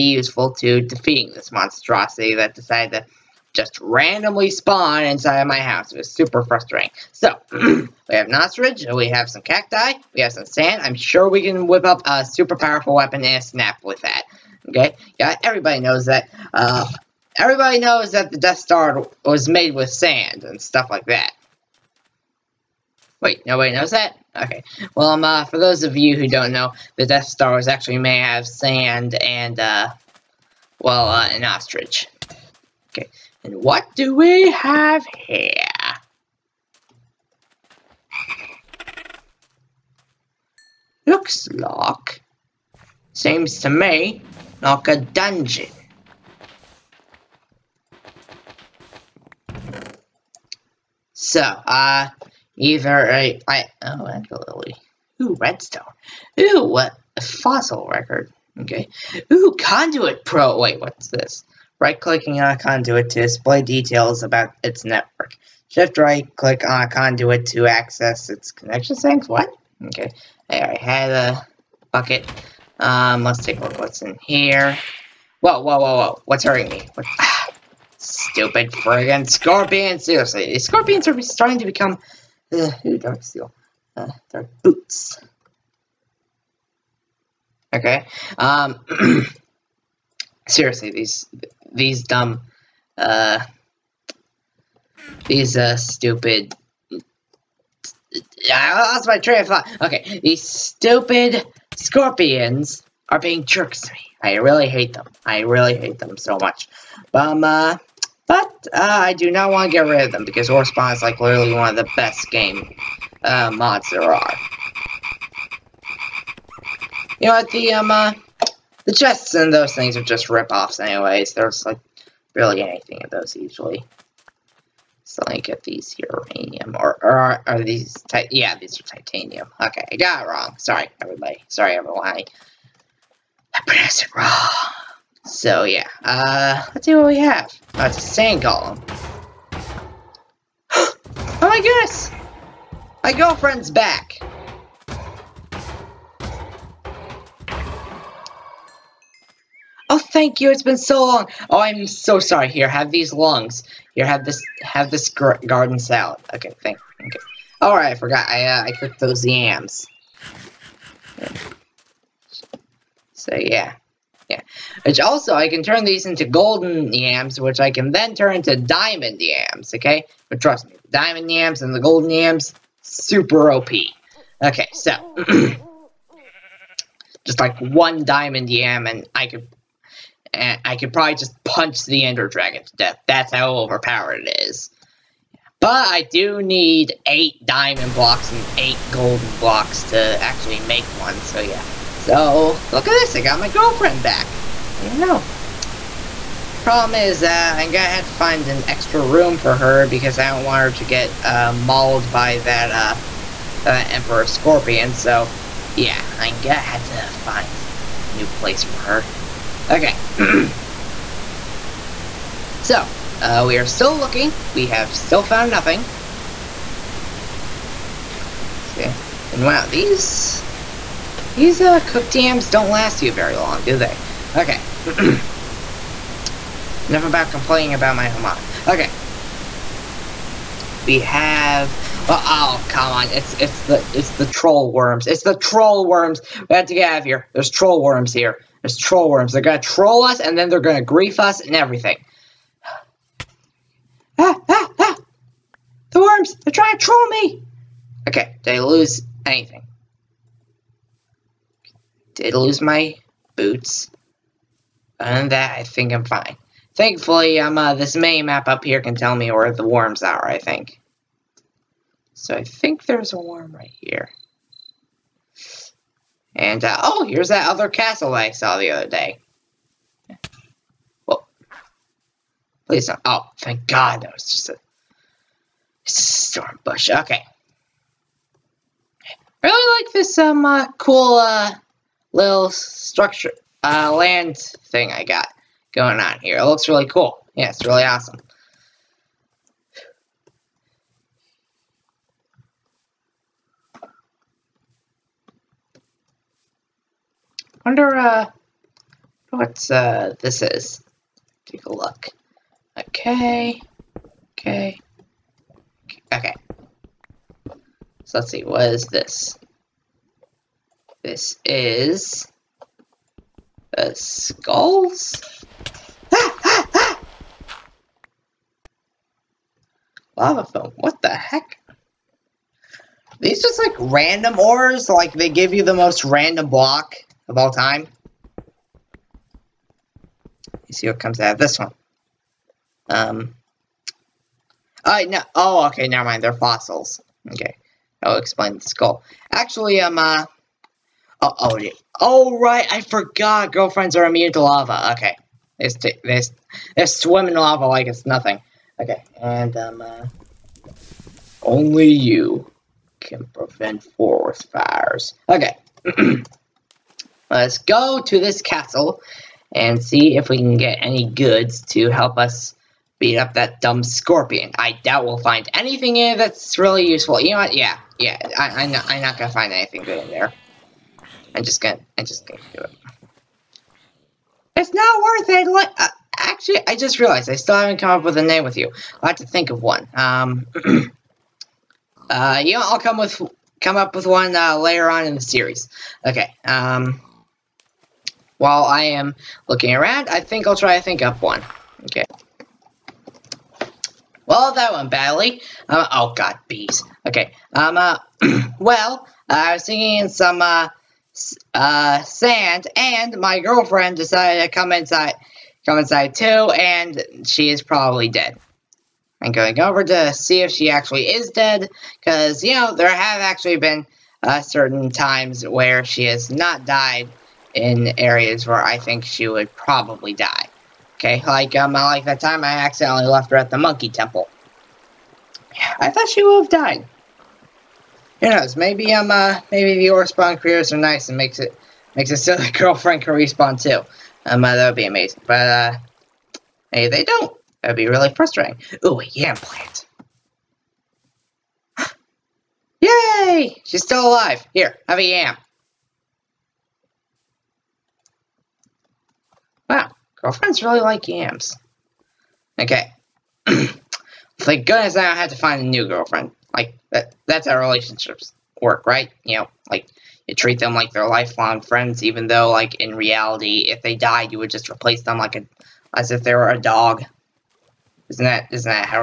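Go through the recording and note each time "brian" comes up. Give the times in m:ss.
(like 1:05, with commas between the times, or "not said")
not said.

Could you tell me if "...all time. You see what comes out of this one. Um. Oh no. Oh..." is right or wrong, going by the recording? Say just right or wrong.
right.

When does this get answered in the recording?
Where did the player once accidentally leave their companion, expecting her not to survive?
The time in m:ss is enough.
7:03.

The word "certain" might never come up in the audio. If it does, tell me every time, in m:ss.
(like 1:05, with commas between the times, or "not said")
6:54.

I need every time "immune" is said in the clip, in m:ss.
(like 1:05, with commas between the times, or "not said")
5:44.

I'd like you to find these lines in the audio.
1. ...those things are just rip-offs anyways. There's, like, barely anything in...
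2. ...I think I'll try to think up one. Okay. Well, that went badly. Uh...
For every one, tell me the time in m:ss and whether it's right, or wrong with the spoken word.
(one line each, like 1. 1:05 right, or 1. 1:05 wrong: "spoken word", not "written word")
1. 1:59 right
2. 6:30 right.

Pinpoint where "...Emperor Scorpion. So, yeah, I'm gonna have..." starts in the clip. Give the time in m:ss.
3:23.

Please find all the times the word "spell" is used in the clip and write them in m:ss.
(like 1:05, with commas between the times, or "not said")
not said.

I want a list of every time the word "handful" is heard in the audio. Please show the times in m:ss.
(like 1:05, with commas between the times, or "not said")
not said.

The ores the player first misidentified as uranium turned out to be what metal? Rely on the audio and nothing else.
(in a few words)
Titanium.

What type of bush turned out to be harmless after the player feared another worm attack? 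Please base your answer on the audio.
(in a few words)
Storm bush.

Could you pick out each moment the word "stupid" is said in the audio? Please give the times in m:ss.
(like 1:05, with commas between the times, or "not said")
1:18, 1:35, 1:40.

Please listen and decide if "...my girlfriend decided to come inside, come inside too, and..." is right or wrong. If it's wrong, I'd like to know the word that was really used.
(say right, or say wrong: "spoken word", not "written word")
right.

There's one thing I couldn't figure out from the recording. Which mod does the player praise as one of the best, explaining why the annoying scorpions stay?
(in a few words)
Orespawn.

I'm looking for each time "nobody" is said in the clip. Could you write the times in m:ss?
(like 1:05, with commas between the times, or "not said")
0:23.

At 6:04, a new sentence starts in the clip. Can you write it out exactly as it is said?
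I doubt we'll find anything in it that's really useful.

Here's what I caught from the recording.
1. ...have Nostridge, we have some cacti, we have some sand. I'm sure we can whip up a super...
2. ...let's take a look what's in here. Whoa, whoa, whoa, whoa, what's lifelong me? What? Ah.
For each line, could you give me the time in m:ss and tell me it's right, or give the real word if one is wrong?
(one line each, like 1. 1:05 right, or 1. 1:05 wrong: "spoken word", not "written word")
1. 0:08 right
2. 1:13 wrong: "hurting", not "lifelong".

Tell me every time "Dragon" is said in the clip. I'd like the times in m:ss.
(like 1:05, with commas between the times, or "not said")
3:02.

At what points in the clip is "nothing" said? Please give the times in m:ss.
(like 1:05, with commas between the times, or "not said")
3:35, 5:48.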